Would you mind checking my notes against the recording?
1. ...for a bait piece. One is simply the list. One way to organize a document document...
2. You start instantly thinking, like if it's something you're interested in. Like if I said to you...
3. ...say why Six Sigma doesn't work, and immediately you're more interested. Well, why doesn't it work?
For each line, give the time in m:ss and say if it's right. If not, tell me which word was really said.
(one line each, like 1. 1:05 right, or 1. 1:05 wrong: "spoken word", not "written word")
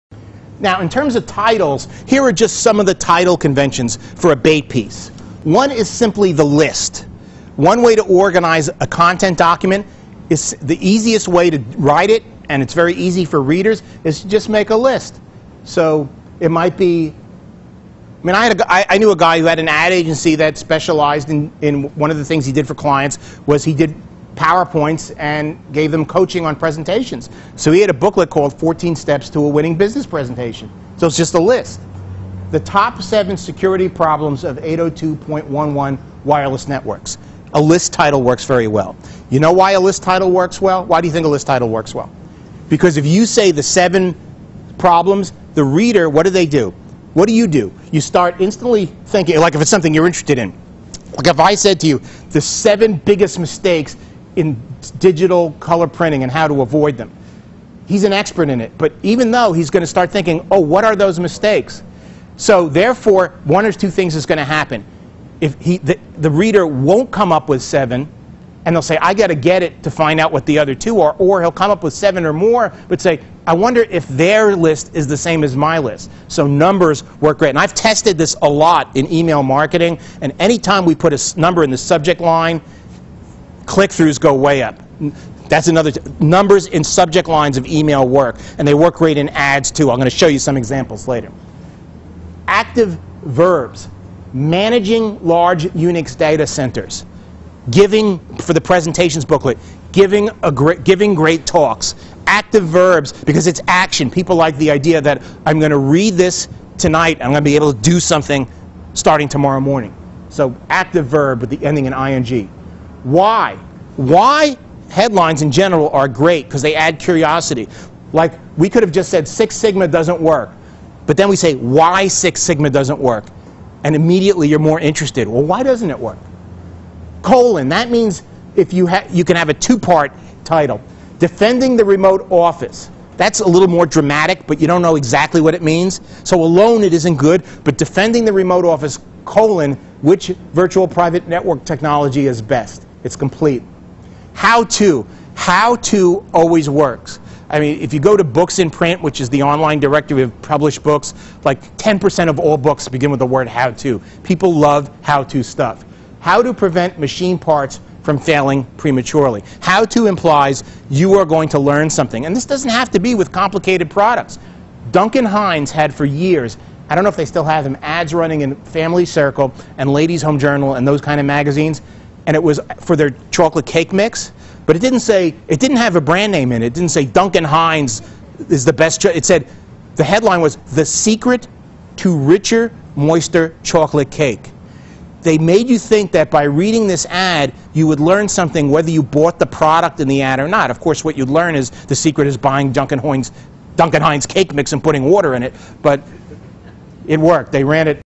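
1. 0:03 wrong: "content", not "document"
2. 0:47 right
3. 2:01 right.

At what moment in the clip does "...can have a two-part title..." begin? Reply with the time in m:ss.
2:09.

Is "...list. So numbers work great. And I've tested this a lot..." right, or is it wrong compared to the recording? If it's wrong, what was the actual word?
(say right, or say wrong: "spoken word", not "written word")
right.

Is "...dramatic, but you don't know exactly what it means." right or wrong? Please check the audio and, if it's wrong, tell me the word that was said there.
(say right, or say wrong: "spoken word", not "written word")
right.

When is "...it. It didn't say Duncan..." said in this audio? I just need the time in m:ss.
2:56.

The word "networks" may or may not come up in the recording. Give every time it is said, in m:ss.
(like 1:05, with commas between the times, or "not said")
0:36, 2:21.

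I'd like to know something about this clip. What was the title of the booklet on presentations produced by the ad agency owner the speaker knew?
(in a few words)
14 Steps to a Winning Business Presentation.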